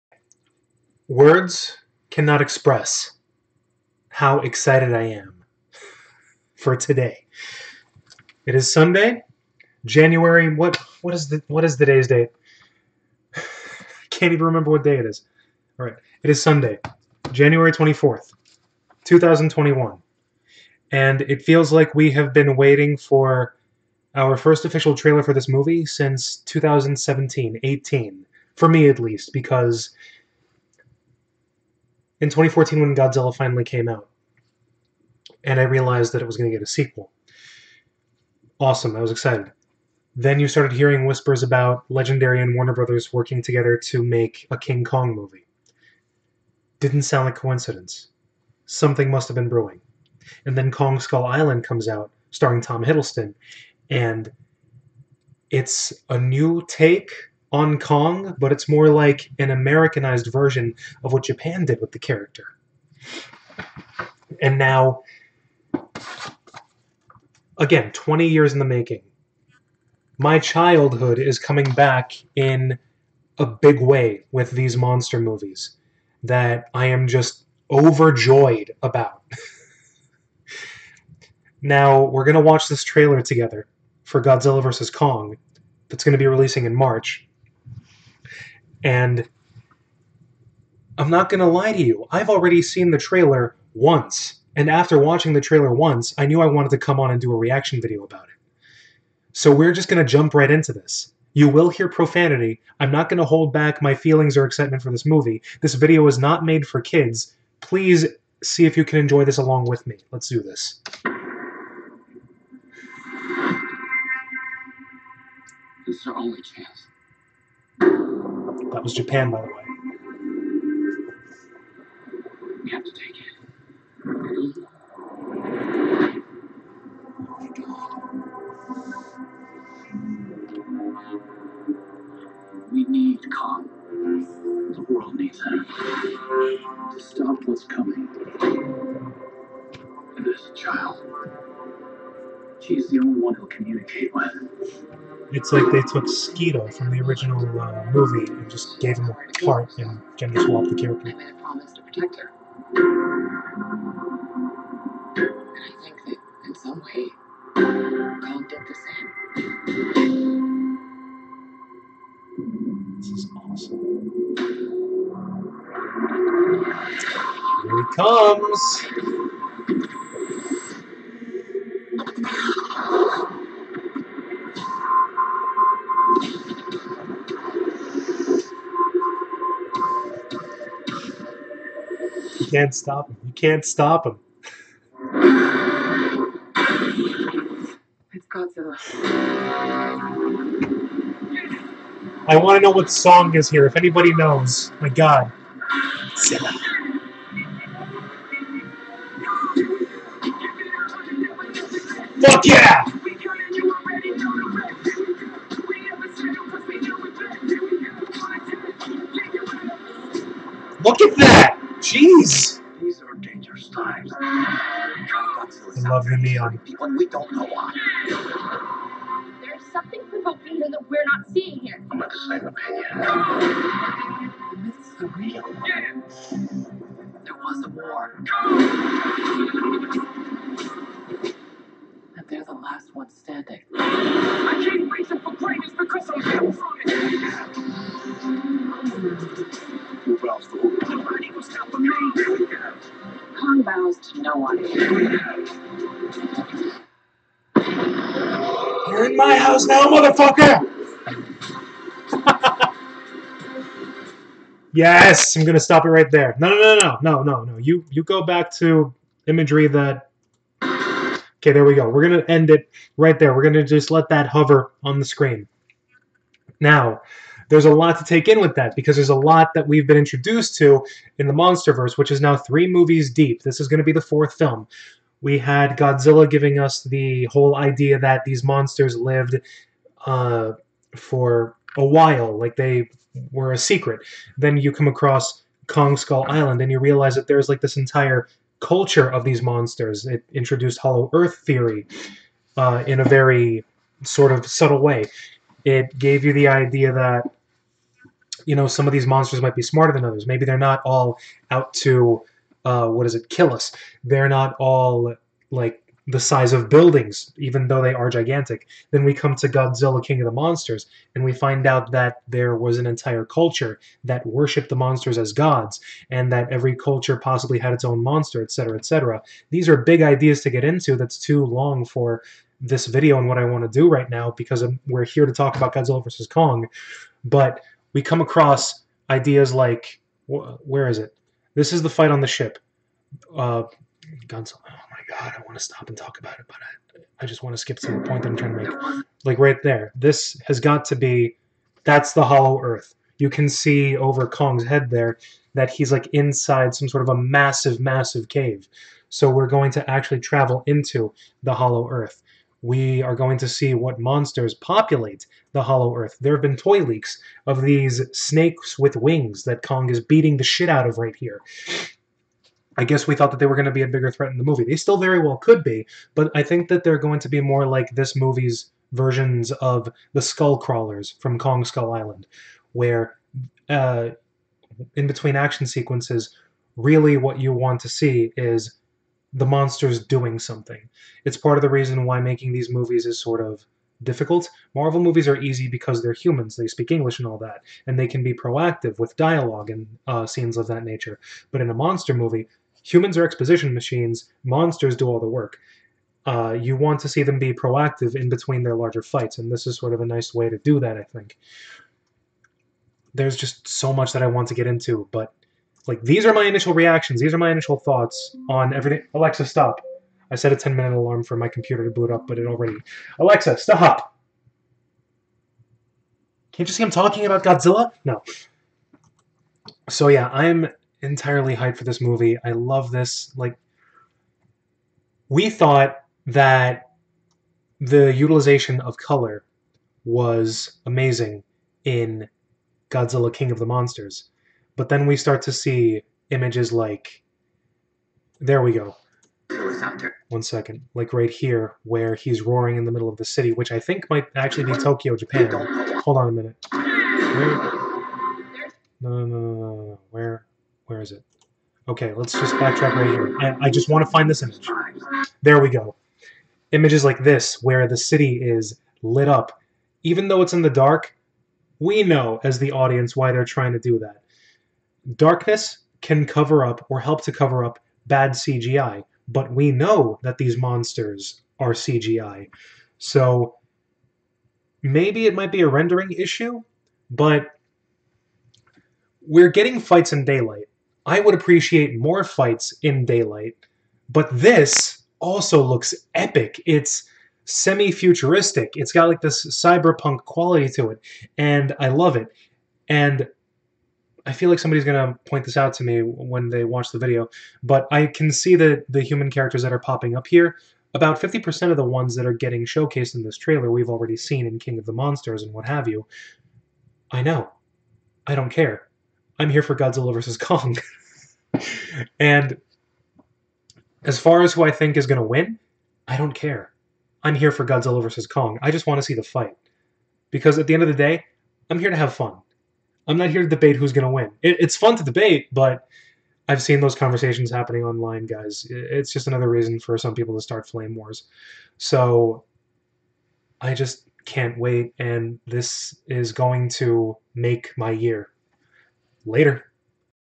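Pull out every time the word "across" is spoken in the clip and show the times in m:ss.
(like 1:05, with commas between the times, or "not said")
4:44, 5:28.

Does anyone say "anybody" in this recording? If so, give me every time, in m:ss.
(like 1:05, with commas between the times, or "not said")
3:13.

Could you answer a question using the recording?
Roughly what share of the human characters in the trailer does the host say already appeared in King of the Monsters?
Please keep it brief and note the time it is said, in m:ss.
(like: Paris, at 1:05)
50%, at 8:21.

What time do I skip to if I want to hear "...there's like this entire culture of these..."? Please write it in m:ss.
4:47.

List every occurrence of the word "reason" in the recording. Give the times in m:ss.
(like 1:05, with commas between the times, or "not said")
3:54, 6:21, 8:49.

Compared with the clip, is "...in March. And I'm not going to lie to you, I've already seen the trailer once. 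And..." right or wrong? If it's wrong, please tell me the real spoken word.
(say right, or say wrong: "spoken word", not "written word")
right.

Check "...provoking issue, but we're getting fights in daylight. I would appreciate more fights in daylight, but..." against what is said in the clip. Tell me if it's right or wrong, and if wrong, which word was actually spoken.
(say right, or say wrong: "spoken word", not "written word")
wrong: "rendering", not "provoking".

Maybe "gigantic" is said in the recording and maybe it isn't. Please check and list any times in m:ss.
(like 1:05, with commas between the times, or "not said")
5:08.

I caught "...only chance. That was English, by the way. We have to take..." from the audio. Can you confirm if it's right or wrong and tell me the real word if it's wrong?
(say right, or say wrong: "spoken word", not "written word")
wrong: "Japan", not "English".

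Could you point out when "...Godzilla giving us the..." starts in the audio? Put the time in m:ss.
4:35.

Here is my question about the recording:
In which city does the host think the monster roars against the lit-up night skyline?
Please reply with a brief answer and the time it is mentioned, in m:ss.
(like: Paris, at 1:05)
Tokyo, Japan, at 7:24.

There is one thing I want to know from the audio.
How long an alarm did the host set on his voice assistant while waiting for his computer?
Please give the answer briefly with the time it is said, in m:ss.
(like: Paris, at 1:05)
10 minutes, at 6:50.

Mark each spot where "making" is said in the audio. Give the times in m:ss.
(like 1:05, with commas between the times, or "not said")
1:08, 6:22.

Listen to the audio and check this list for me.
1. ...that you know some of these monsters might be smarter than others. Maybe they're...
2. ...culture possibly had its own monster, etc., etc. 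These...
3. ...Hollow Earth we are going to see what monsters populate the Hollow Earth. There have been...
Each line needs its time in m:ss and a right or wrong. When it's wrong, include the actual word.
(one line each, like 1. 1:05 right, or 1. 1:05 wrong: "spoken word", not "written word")
1. 4:56 right
2. 5:16 right
3. 5:51 right.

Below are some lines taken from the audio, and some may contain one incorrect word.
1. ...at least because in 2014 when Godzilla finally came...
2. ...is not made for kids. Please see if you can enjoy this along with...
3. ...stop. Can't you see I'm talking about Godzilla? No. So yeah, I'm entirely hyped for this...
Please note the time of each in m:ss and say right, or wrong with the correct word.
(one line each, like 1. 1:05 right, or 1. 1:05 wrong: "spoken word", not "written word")
1. 0:28 right
2. 1:46 right
3. 6:53 right.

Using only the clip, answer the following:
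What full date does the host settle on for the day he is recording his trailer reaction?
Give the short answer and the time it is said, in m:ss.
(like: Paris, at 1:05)
Sunday, January 24, 2021, at 0:16.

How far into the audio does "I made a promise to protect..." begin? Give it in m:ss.
2:31.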